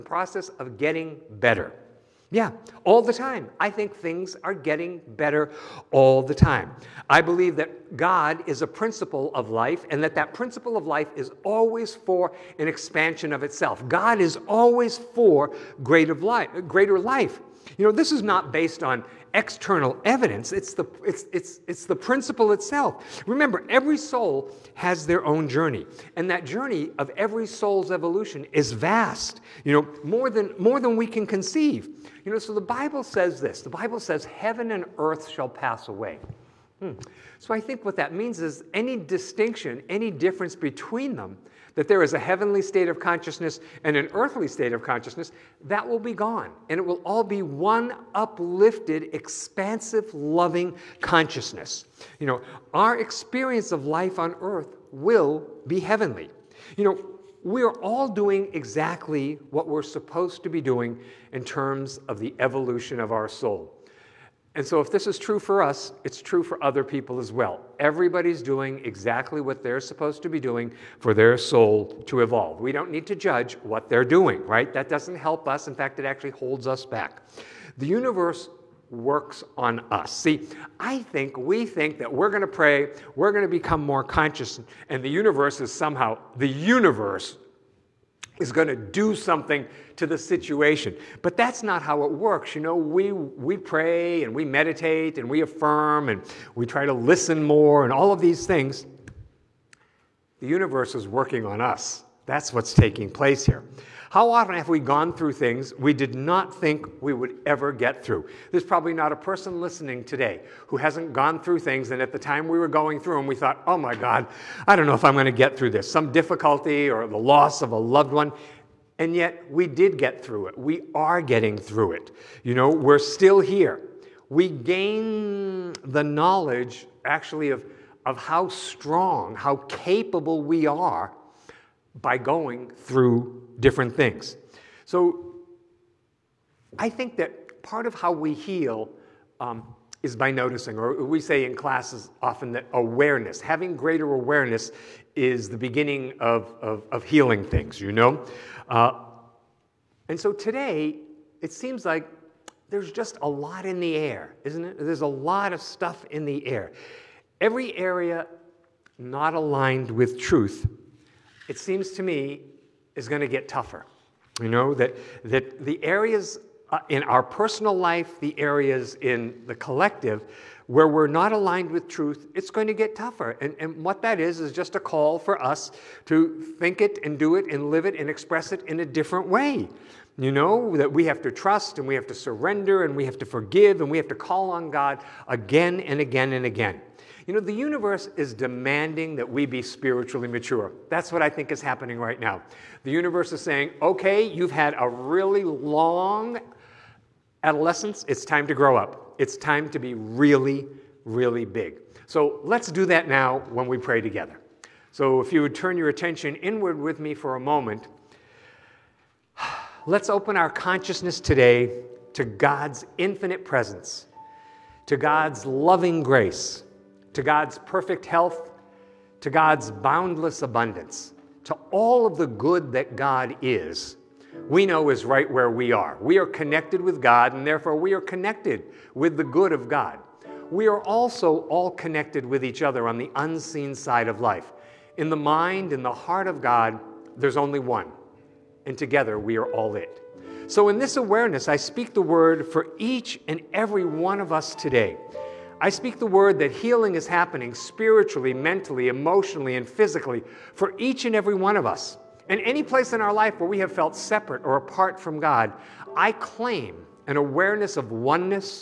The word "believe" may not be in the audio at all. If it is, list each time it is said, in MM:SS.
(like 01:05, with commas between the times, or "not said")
00:07.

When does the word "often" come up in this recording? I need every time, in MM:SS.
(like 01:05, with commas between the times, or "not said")
01:44, 02:22.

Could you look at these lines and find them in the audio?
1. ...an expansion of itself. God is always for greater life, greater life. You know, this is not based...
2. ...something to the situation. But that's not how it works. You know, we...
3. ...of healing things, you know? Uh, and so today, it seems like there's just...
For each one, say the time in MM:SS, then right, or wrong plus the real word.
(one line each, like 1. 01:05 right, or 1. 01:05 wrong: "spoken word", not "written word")
1. 00:12 right
2. 01:29 right
3. 02:26 right.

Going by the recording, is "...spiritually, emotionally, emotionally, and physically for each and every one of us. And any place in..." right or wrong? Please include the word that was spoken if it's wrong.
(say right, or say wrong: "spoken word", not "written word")
wrong: "mentally", not "emotionally".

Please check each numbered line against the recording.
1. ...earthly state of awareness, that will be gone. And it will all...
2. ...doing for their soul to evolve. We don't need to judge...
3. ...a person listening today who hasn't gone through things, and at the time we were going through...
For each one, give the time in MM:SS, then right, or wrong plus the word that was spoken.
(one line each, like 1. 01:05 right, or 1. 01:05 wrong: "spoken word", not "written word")
1. 00:44 wrong: "consciousness", not "awareness"
2. 01:10 right
3. 01:49 right.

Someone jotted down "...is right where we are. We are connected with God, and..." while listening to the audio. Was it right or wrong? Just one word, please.
right.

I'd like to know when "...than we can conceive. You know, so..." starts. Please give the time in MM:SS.
00:30.